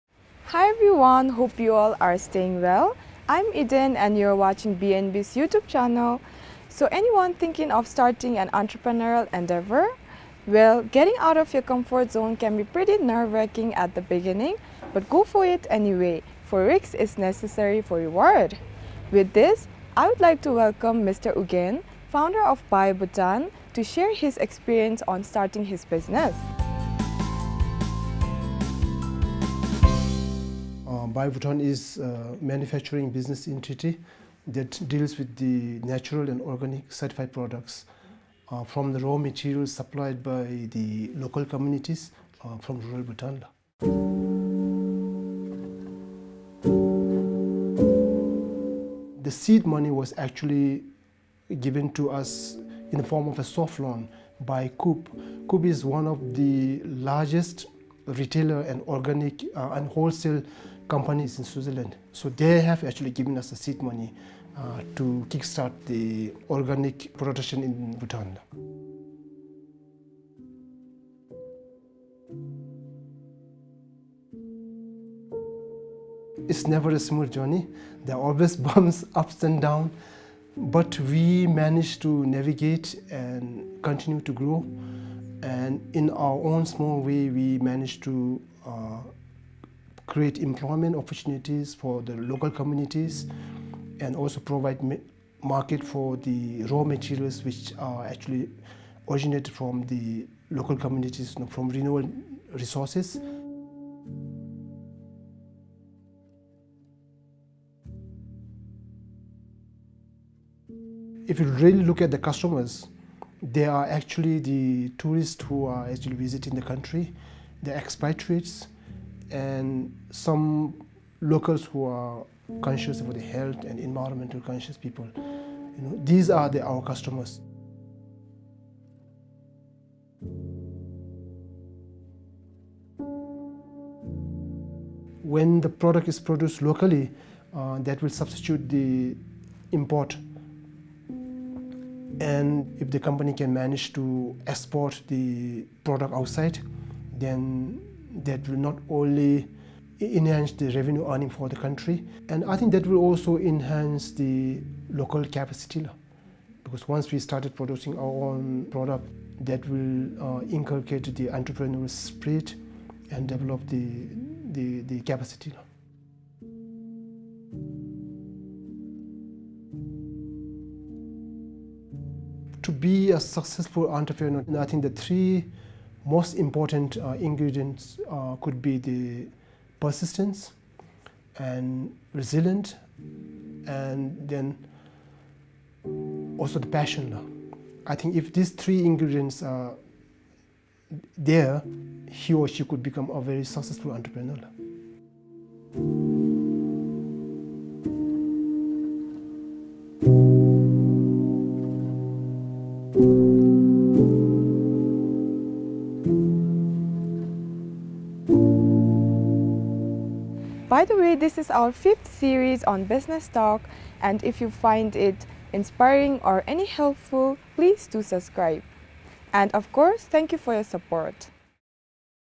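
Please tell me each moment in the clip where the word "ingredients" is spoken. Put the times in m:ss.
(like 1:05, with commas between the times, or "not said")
2:57, 3:08.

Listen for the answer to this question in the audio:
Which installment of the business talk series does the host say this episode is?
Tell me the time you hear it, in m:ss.
3:31.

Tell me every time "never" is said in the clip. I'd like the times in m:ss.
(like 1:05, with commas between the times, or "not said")
1:16.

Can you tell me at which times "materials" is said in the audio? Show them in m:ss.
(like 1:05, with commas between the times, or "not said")
0:39, 1:36.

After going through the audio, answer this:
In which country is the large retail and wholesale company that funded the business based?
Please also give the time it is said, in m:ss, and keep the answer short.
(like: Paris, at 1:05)
Switzerland, at 1:01.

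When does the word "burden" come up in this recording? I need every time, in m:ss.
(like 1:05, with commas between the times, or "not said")
not said.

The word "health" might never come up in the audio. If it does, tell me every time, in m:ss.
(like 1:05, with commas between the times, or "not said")
2:03.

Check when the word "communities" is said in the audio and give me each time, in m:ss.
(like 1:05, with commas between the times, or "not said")
0:41, 1:32, 1:40.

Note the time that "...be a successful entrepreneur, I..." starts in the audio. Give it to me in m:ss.
2:52.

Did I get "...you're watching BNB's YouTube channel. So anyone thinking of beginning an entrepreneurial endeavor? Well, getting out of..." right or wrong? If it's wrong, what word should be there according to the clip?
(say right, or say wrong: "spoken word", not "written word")
wrong: "starting", not "beginning".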